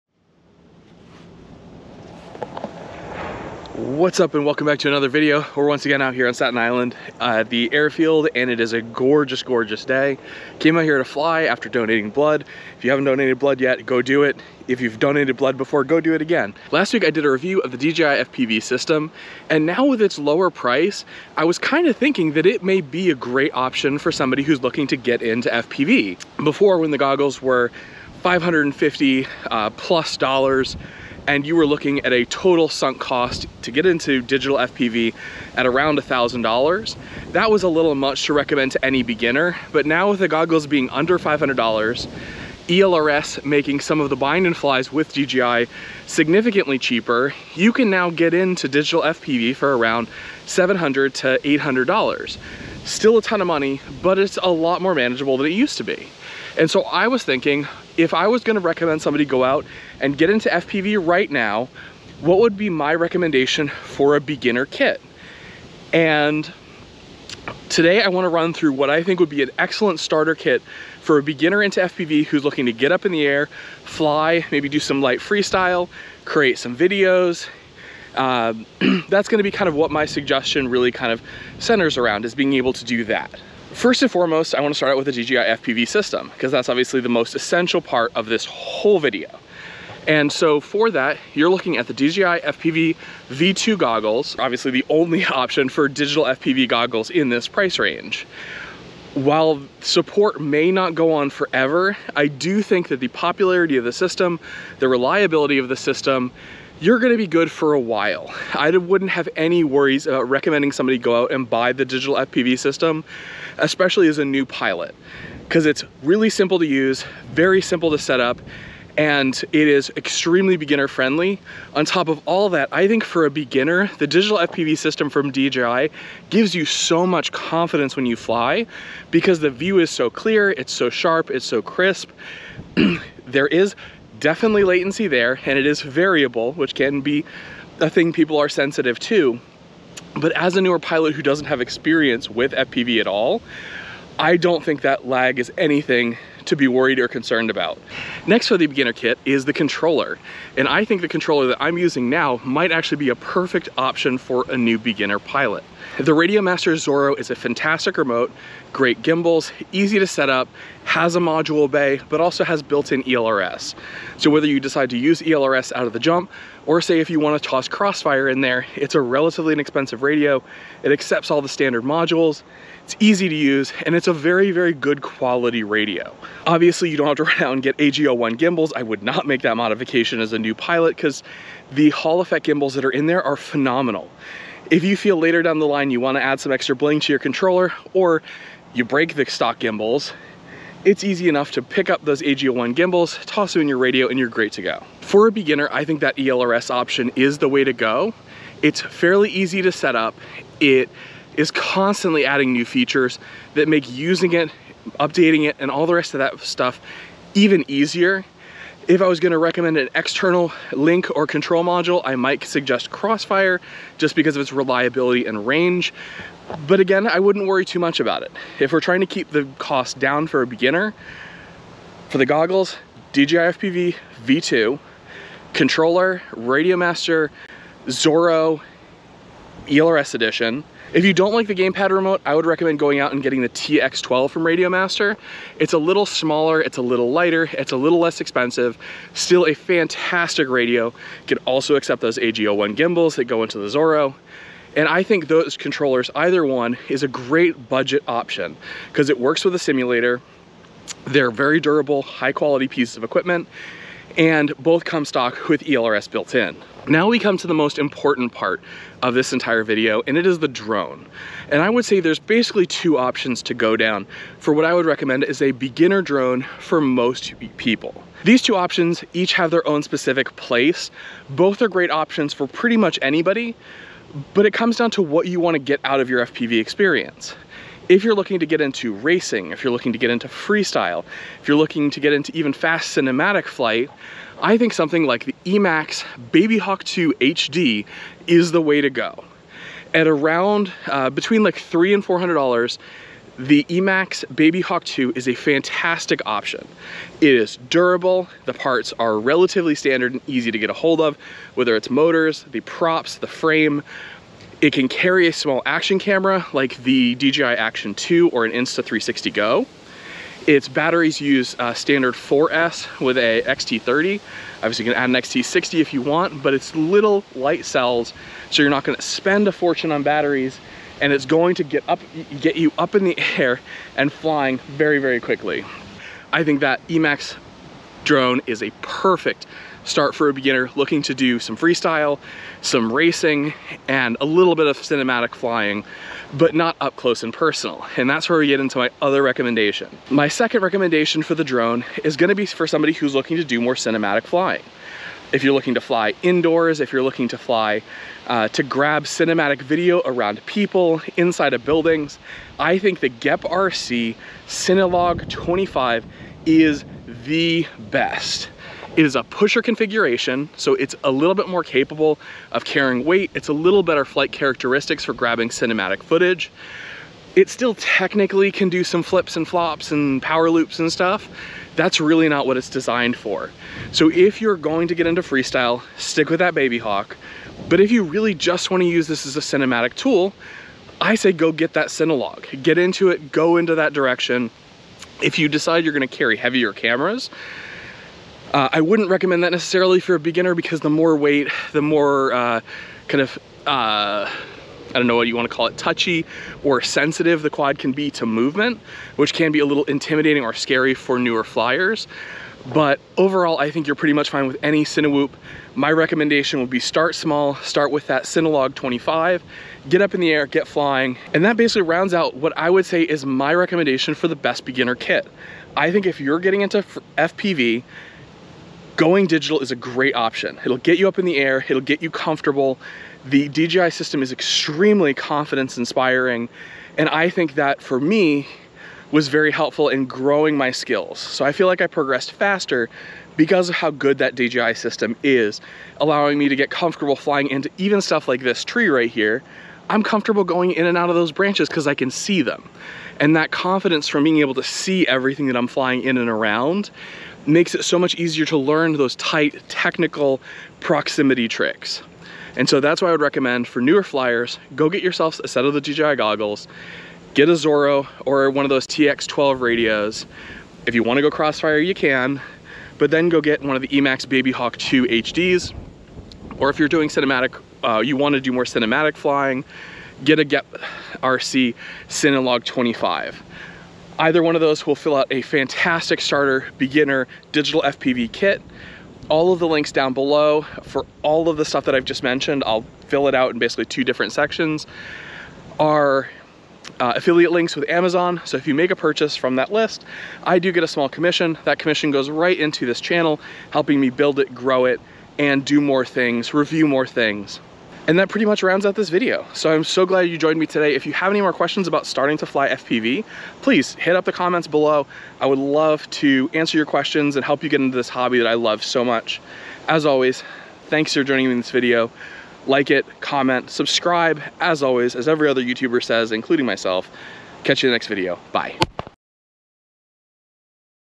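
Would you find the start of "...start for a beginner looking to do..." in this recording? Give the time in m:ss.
5:29.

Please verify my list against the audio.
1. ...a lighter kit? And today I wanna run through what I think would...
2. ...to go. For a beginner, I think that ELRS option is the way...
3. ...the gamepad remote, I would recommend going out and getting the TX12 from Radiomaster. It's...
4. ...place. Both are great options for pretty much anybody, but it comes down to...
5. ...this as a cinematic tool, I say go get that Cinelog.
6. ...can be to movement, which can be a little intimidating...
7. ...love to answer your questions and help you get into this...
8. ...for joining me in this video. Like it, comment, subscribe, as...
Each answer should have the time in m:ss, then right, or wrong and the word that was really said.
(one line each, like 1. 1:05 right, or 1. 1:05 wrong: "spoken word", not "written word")
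1. 1:04 wrong: "beginner", not "lighter"
2. 3:14 right
3. 3:51 right
4. 4:30 right
5. 6:19 right
6. 6:37 right
7. 8:25 right
8. 8:31 right.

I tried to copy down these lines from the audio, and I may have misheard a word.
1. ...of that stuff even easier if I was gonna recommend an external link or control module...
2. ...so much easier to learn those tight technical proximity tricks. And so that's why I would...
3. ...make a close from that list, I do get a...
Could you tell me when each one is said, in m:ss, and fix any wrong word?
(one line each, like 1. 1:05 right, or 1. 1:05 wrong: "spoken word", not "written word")
1. 3:26 right
2. 7:27 right
3. 8:08 wrong: "purchase", not "close".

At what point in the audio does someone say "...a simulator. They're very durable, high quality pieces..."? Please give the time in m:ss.
4:09.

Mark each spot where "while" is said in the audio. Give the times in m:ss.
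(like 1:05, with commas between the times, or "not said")
1:39, 1:47.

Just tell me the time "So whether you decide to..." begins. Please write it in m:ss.
2:44.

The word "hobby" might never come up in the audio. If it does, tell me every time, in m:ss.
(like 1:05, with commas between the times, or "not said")
8:28.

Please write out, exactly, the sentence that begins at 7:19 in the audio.
I'm comfortable going in and out of those branches because I can see them.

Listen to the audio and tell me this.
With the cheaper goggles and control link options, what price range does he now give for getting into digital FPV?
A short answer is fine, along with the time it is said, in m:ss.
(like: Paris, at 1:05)
$700 to $800, at 0:50.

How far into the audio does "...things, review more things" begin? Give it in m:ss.
8:16.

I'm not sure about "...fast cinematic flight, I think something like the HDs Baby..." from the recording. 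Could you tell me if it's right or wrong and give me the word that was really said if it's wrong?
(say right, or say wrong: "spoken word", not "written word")
wrong: "Emax", not "HDs".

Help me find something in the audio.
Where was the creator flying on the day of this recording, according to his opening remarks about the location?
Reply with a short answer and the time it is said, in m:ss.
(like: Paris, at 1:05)
Staten Island, at 0:06.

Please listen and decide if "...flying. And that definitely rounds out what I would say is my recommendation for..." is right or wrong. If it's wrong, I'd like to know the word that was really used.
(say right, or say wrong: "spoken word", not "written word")
wrong: "basically", not "definitely".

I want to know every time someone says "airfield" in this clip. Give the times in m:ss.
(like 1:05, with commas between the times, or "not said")
0:07.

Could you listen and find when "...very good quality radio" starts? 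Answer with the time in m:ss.
2:54.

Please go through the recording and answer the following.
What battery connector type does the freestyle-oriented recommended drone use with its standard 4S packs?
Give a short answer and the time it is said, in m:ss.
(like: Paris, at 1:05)
XT30, at 5:13.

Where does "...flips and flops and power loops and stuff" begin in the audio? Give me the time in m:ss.
6:09.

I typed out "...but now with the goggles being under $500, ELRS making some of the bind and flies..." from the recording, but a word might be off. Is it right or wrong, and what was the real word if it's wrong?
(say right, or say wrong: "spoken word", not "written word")
right.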